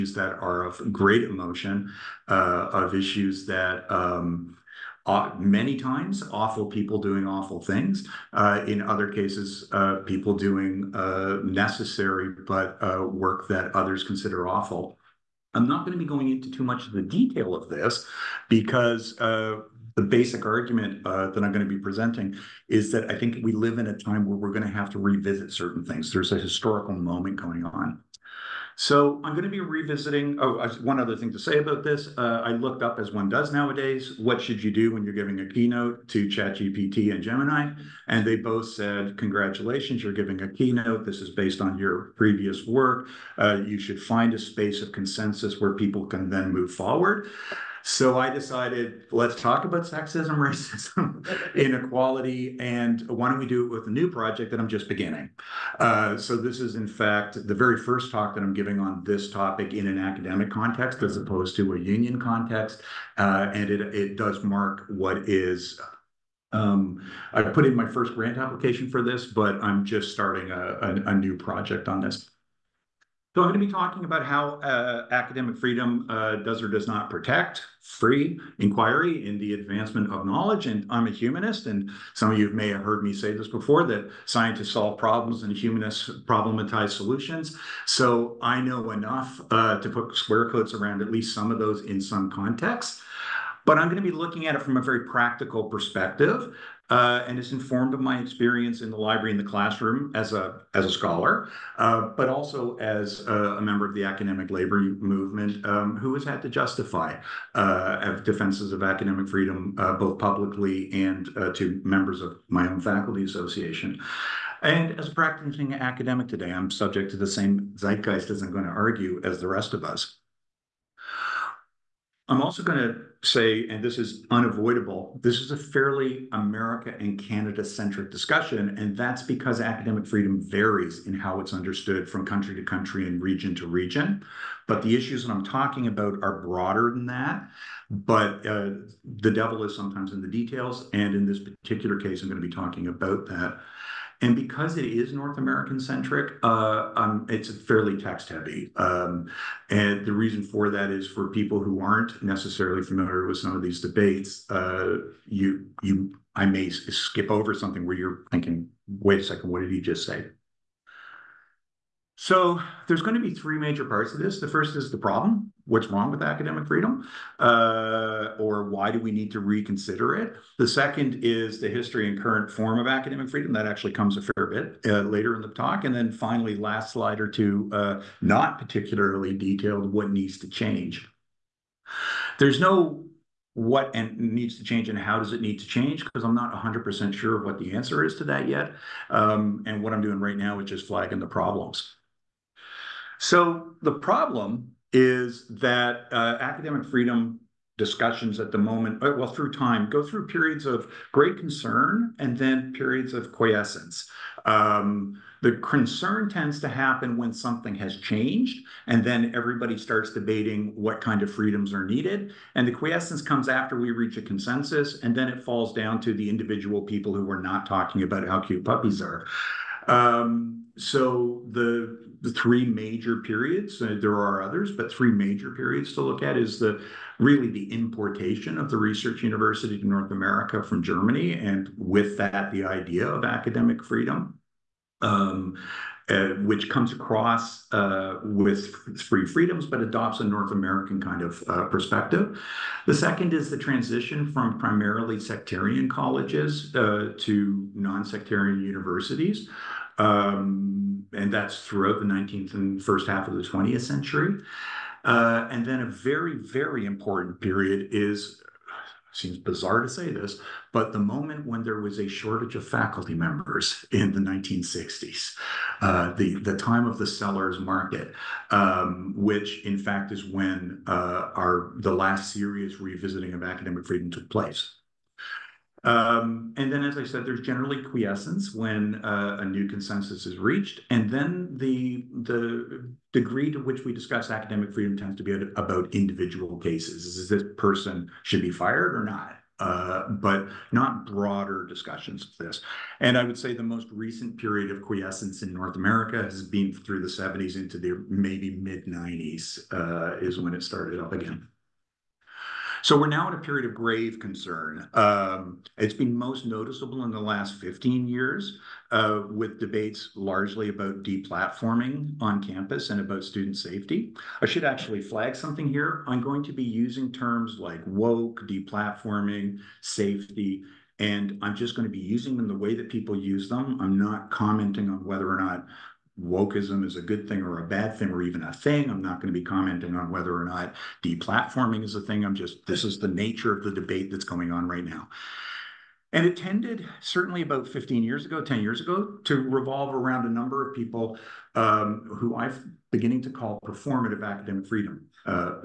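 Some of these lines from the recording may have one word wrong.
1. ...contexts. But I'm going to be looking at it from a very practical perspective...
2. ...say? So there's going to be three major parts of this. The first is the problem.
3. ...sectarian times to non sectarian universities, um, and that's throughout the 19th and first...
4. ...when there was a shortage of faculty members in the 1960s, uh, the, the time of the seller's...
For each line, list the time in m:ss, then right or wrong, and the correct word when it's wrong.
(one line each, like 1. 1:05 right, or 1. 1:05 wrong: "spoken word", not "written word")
1. 1:32 right
2. 2:40 right
3. 4:05 wrong: "colleges", not "times"
4. 4:21 right.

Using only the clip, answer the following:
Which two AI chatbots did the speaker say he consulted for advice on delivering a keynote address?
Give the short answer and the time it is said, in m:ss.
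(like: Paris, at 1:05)
ChatGPT and Gemini, at 0:36.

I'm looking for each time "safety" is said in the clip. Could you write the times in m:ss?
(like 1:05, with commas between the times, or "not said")
5:13, 5:19.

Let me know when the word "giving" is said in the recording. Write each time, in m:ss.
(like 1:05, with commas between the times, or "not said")
0:35, 0:40, 0:58.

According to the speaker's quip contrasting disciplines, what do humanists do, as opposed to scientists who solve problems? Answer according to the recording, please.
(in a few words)
problematize solutions.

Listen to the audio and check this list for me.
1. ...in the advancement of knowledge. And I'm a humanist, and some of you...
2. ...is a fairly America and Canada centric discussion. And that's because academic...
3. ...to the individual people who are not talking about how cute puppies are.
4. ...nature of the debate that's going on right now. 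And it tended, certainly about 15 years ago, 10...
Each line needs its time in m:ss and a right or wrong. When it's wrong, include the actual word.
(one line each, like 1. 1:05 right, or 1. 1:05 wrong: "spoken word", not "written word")
1. 1:19 right
2. 2:05 right
3. 3:36 right
4. 5:33 right.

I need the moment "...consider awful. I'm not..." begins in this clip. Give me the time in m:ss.
0:14.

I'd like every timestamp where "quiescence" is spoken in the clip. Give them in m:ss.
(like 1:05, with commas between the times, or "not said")
3:23, 3:32, 4:37, 4:54.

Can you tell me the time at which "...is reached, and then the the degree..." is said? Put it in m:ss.
4:40.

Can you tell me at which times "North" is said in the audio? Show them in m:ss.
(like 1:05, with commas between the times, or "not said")
2:25, 3:49, 4:00, 4:55.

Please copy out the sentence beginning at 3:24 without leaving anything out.
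Um, the concern tends to happen when something has changed, and then everybody starts debating what kind of freedoms are needed.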